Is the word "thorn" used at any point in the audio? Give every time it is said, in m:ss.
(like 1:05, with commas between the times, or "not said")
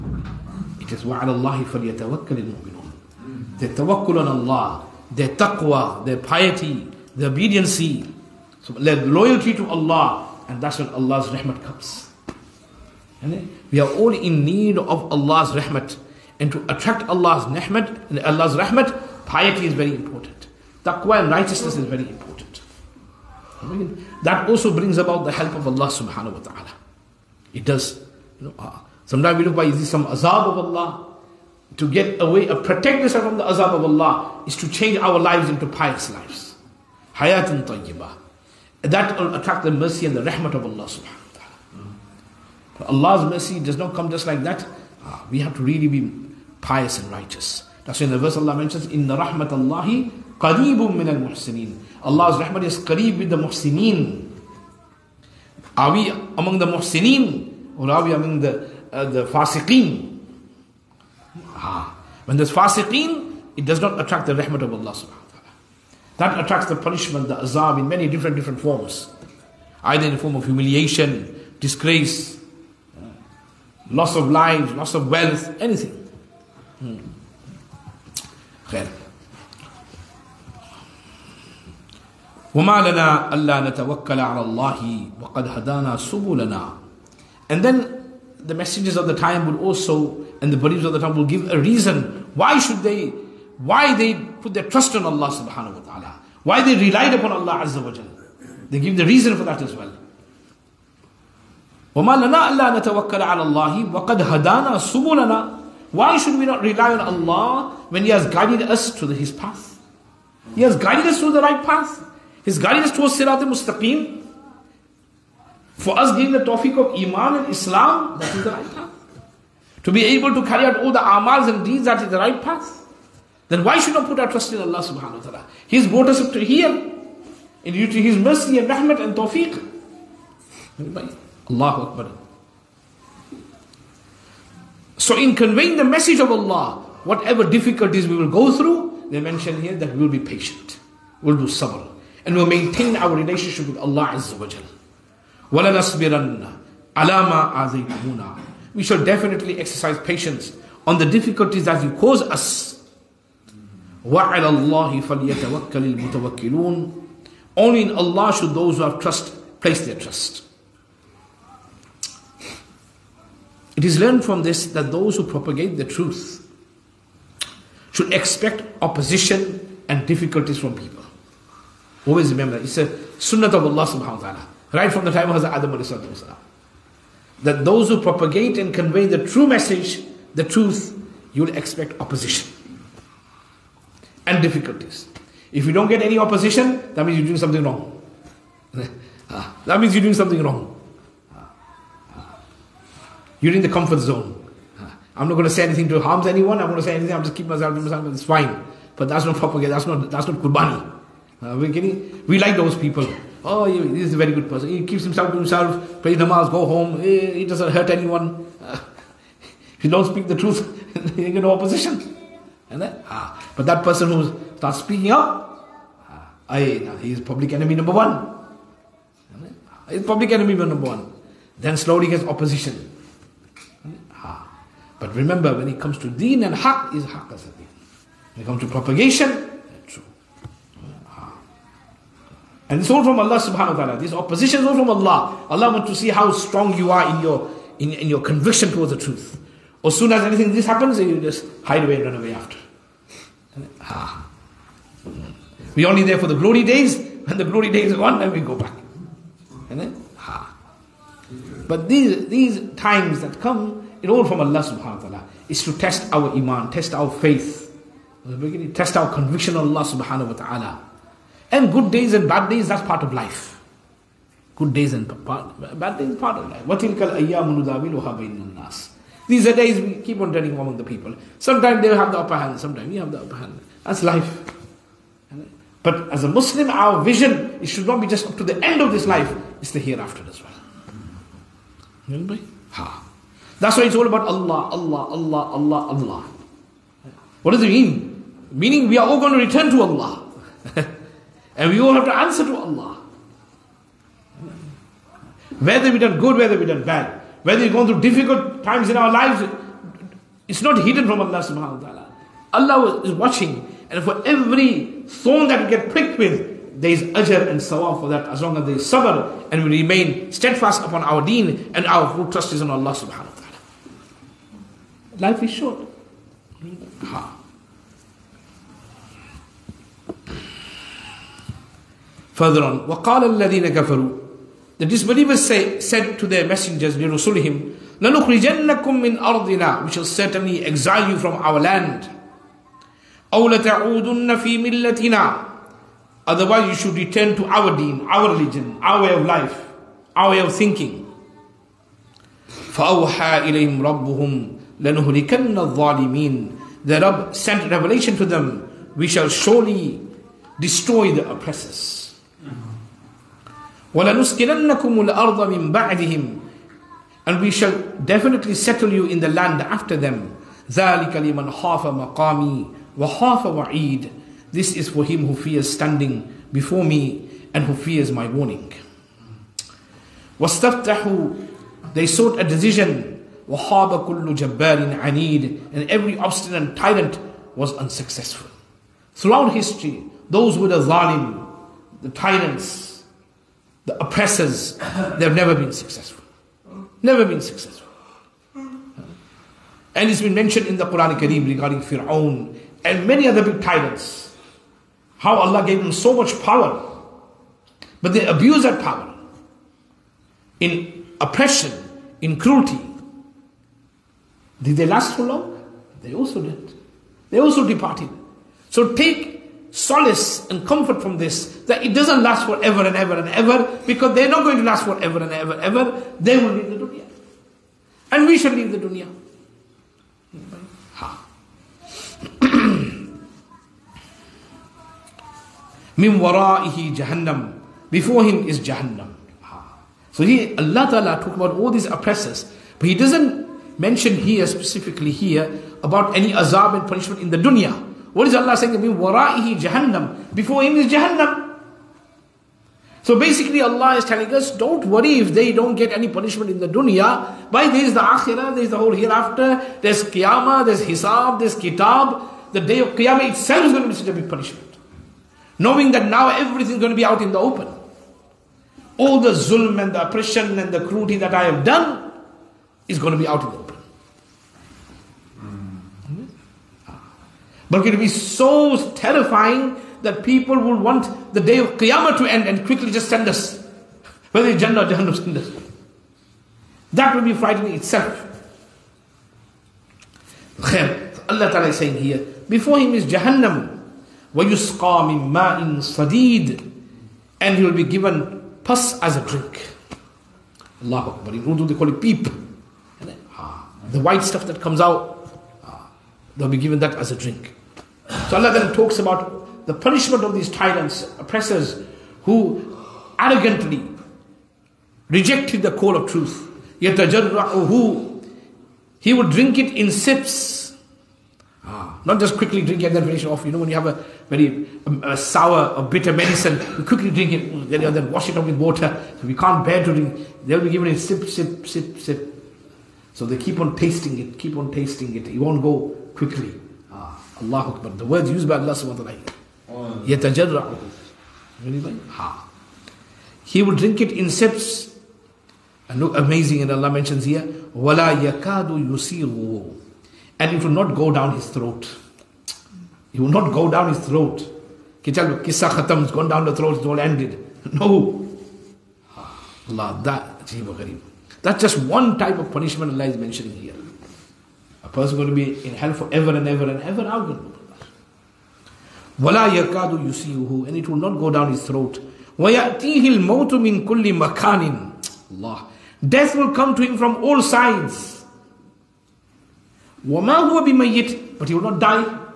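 5:05.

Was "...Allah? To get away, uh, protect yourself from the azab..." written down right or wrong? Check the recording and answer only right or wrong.
right.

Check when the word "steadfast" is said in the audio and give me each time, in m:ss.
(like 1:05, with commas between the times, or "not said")
5:10.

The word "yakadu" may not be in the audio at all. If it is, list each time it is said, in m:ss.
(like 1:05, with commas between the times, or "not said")
8:58.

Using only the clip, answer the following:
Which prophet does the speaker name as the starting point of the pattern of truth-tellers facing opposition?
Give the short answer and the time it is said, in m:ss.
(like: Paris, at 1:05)
Hazrat Adam, at 2:55.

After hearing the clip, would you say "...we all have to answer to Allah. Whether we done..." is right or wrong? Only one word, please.
right.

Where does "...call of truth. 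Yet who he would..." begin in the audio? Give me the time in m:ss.
8:25.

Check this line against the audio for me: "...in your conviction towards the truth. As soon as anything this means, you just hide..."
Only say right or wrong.
wrong.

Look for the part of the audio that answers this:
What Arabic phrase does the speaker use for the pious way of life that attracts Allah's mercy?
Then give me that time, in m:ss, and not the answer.
0:37.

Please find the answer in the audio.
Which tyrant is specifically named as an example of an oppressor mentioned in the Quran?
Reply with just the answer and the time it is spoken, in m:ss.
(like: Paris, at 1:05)
Fir'aun, at 6:31.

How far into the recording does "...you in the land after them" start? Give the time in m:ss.
5:58.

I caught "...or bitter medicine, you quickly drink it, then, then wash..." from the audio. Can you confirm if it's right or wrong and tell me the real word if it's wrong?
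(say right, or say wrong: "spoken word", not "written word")
right.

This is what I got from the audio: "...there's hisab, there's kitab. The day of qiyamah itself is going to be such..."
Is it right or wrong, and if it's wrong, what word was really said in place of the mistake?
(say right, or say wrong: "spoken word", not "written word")
right.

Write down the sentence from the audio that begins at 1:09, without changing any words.
Either in the form of humiliation, disgrace, loss of lives, loss of wealth, anything.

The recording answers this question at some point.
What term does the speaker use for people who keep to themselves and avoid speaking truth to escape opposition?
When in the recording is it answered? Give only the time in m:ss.
3:13.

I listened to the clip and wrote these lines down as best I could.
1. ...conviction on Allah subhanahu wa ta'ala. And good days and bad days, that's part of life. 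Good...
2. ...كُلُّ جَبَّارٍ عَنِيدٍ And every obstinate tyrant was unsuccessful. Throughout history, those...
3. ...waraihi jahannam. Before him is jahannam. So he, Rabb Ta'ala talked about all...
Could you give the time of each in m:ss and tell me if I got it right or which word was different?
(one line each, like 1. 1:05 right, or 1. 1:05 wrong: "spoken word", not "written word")
1. 4:19 right
2. 6:14 right
3. 7:06 wrong: "Allah", not "Rabb".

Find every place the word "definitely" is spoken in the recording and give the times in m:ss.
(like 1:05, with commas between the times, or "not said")
2:29, 5:58.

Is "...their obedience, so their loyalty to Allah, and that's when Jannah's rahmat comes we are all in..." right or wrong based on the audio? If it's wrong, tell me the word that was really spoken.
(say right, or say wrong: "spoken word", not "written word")
wrong: "Allah", not "Jannah".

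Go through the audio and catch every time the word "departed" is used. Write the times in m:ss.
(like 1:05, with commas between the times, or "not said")
6:47.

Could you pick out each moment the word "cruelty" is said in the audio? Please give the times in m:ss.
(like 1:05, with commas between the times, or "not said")
6:42, 7:40.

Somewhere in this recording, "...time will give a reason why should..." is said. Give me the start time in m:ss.
1:30.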